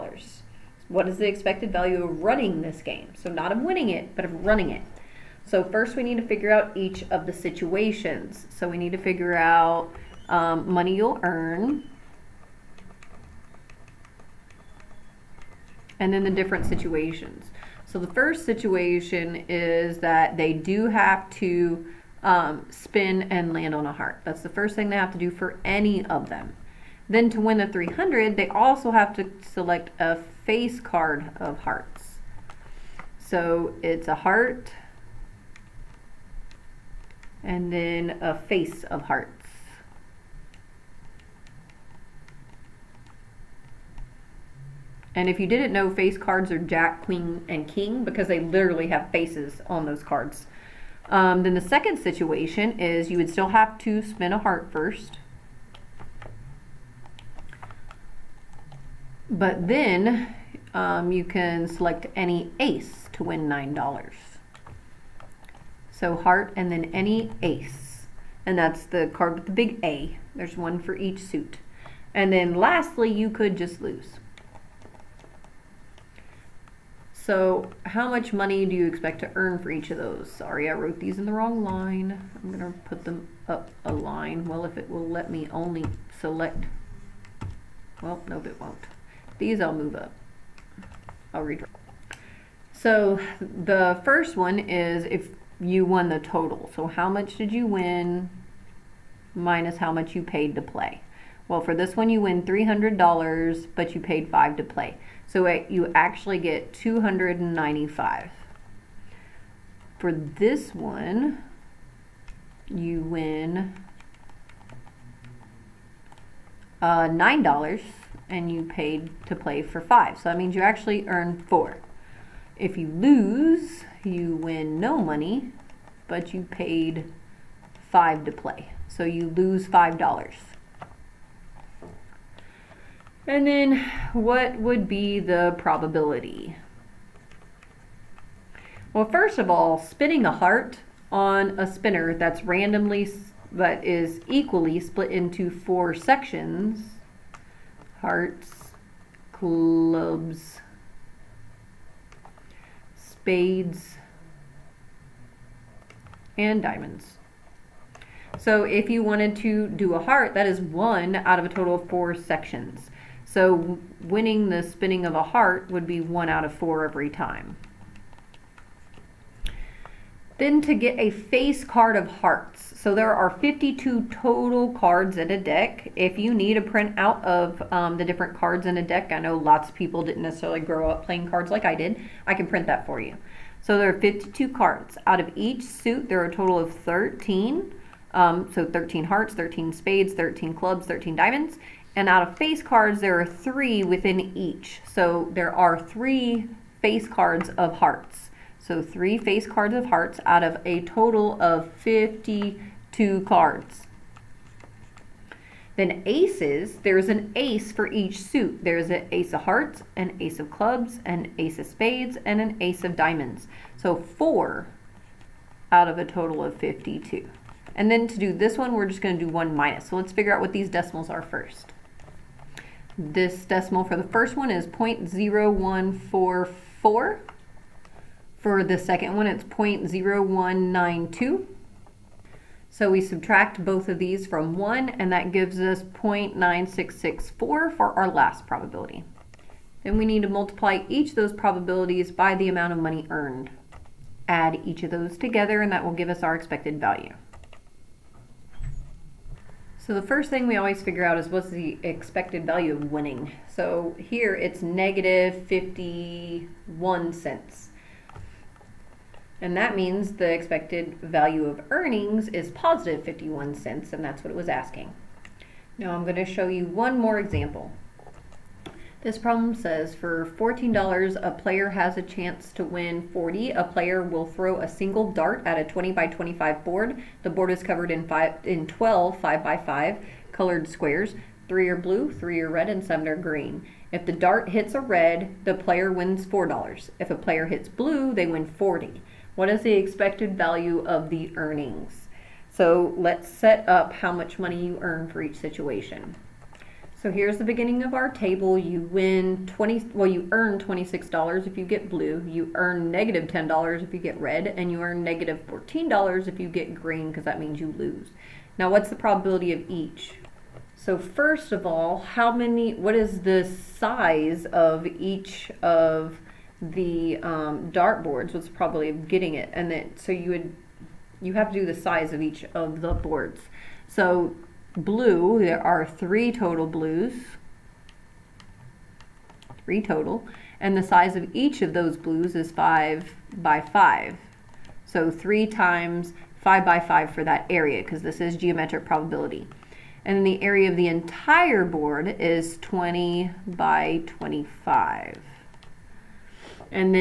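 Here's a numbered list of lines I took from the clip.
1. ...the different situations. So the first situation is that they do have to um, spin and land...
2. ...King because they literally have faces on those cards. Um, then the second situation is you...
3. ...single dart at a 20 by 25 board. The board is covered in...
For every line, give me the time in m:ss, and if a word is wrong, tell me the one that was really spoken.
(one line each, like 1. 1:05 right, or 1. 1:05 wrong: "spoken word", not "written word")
1. 0:16 right
2. 0:47 right
3. 4:34 right.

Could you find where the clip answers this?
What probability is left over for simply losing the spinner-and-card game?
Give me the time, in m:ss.
3:55.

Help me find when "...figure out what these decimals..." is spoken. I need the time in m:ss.
3:40.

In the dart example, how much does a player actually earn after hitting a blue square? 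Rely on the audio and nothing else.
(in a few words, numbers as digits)
$26.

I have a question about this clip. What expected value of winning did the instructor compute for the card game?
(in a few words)
-51 cents.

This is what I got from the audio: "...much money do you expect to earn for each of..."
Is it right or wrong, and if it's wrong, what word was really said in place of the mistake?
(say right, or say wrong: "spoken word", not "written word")
right.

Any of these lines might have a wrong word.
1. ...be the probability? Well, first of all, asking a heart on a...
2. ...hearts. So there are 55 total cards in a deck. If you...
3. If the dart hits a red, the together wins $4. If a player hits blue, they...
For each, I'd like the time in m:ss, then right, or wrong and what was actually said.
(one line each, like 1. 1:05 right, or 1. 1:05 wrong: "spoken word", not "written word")
1. 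2:14 wrong: "spinning", not "asking"
2. 2:52 wrong: "52", not "55"
3. 4:43 wrong: "player", not "together".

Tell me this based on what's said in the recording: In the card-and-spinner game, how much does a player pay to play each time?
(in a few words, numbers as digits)
$5.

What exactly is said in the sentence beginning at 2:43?
So winning the spinning of a heart would be one out of four every time.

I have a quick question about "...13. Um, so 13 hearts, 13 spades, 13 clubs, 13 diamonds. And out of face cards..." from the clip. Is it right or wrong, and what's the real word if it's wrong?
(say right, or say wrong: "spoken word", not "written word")
right.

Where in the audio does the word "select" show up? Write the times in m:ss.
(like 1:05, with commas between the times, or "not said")
0:29, 1:01, 1:26.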